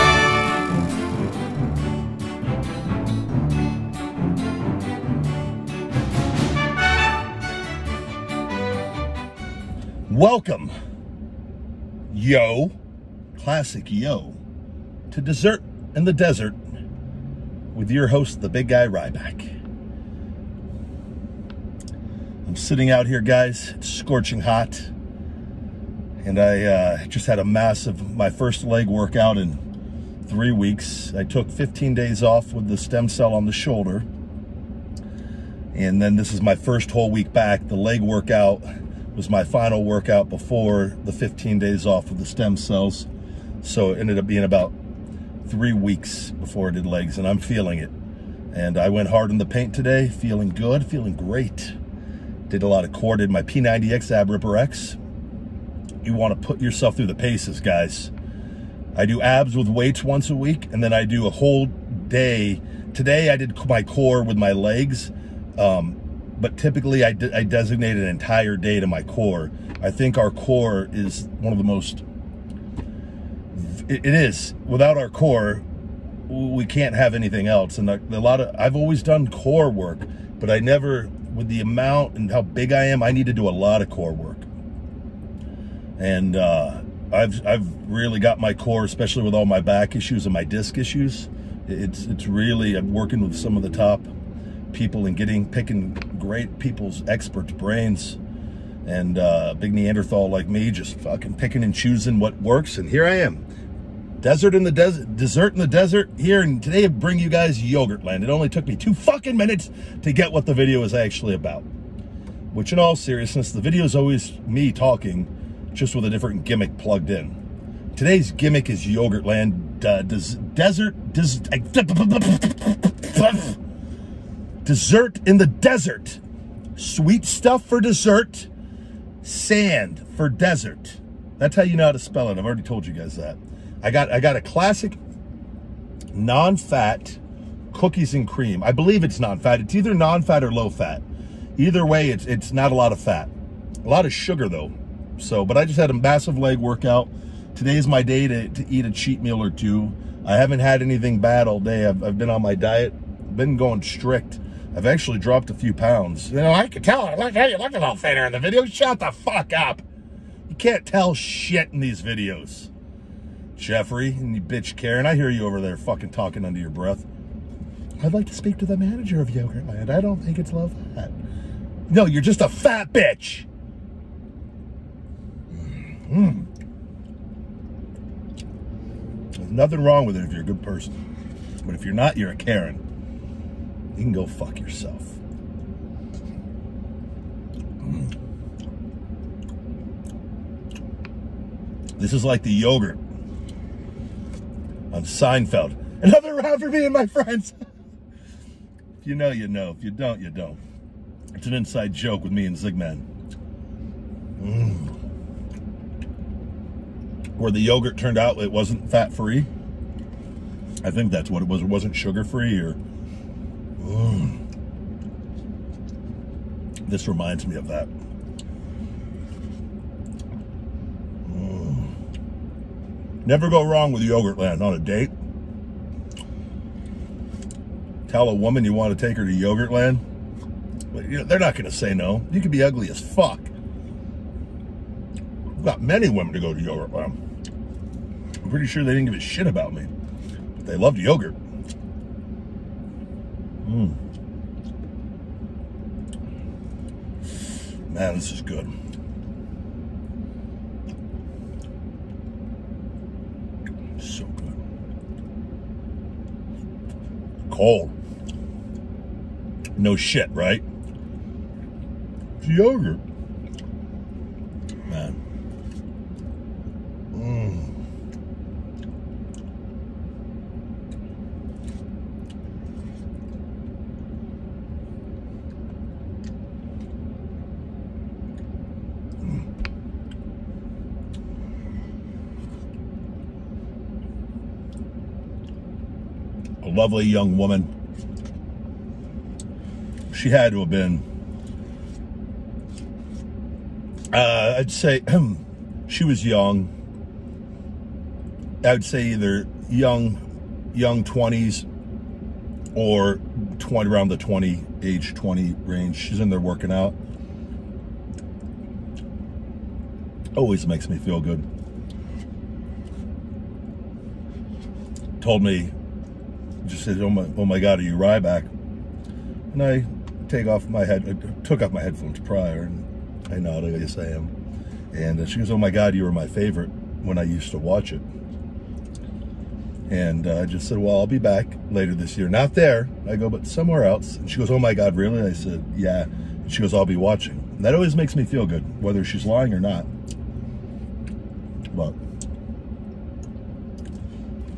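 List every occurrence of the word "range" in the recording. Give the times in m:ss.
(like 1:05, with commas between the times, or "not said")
5:05.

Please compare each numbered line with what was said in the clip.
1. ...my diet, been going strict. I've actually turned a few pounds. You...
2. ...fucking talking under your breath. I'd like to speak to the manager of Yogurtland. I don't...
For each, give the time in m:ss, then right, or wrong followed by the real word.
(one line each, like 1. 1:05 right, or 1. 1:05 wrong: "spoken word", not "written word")
1. 2:32 wrong: "dropped", not "turned"
2. 2:45 right.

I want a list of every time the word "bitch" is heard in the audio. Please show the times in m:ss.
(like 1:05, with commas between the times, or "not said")
2:44, 2:52.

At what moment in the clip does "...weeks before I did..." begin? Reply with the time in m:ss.
0:45.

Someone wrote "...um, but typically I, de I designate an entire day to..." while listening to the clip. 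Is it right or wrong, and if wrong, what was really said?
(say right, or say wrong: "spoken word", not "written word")
right.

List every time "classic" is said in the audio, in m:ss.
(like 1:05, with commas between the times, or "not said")
0:13, 2:14.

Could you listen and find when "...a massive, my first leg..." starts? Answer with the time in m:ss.
0:27.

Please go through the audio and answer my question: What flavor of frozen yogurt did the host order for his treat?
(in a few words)
Cookies and cream.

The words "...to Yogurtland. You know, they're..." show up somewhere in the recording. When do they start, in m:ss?
3:49.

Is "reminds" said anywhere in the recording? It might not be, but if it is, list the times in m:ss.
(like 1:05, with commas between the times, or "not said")
3:37.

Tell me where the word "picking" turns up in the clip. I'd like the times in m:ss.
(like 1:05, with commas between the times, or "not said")
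1:35, 1:41.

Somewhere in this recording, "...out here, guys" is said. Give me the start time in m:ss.
0:22.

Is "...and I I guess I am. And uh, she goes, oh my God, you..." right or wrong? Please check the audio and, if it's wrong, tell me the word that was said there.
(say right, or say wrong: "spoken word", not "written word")
right.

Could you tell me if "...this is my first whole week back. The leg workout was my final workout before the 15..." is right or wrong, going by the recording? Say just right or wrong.
right.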